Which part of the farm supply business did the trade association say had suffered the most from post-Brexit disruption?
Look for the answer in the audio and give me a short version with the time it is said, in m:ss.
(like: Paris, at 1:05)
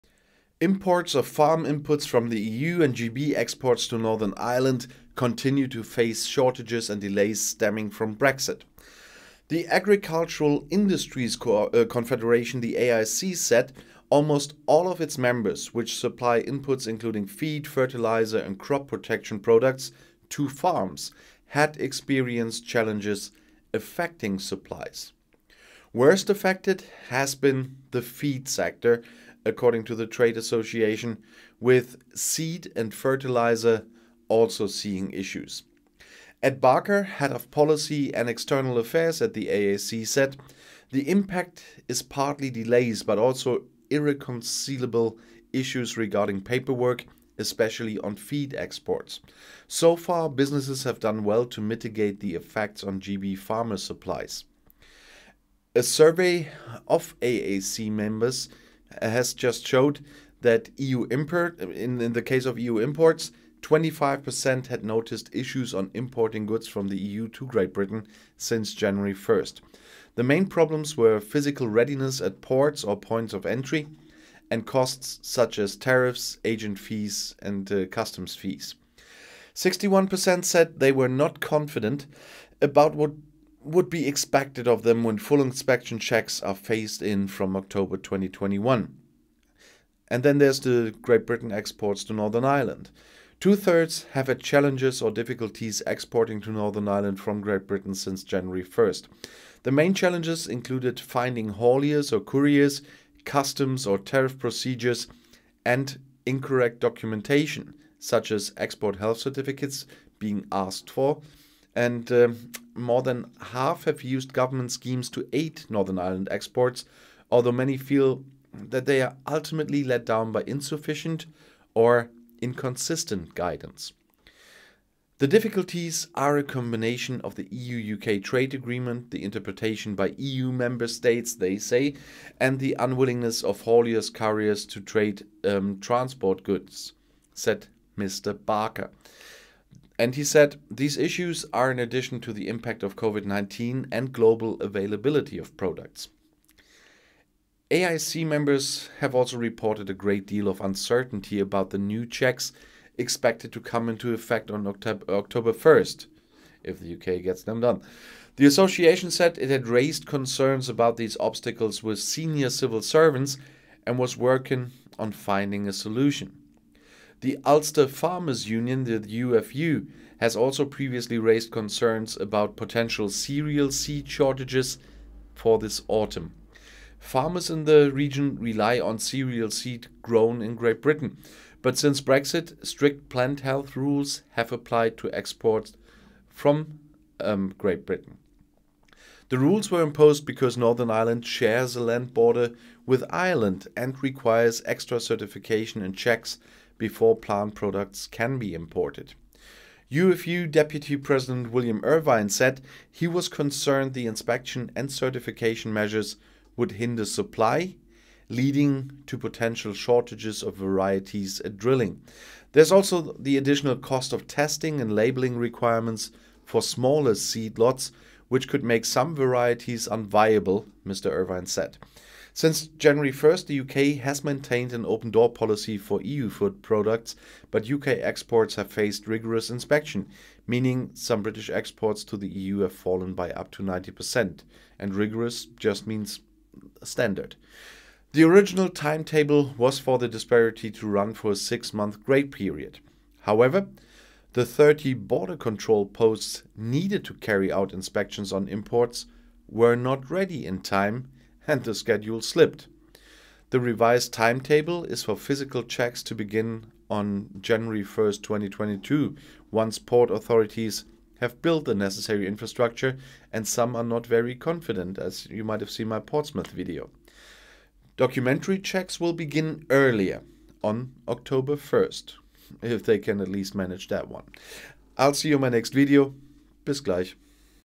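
Feed sector, at 0:28.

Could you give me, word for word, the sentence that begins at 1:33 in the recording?
Two thirds have had challenges or difficulties exporting to Northern Ireland from Great Britain since January 1st.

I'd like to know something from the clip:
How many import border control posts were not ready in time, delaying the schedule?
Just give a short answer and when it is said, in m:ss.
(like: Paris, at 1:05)
30, at 4:04.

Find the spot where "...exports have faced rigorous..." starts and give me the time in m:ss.
3:47.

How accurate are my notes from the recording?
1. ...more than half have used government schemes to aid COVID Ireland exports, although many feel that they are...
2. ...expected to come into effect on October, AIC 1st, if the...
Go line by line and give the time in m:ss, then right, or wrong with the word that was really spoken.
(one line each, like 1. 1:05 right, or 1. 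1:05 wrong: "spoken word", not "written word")
1. 1:52 wrong: "Northern", not "COVID"
2. 2:32 wrong: "October", not "AIC".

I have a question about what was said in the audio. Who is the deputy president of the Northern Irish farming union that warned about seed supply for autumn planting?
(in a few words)
William Irvine.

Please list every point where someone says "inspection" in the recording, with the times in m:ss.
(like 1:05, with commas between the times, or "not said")
1:25, 3:24, 3:49, 4:07.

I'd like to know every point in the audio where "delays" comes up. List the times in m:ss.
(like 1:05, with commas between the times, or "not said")
0:07, 0:42.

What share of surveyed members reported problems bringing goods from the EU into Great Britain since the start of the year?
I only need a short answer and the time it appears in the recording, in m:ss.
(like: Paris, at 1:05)
25%, at 1:03.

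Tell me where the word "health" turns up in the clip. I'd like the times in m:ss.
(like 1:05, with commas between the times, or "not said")
1:48, 3:03.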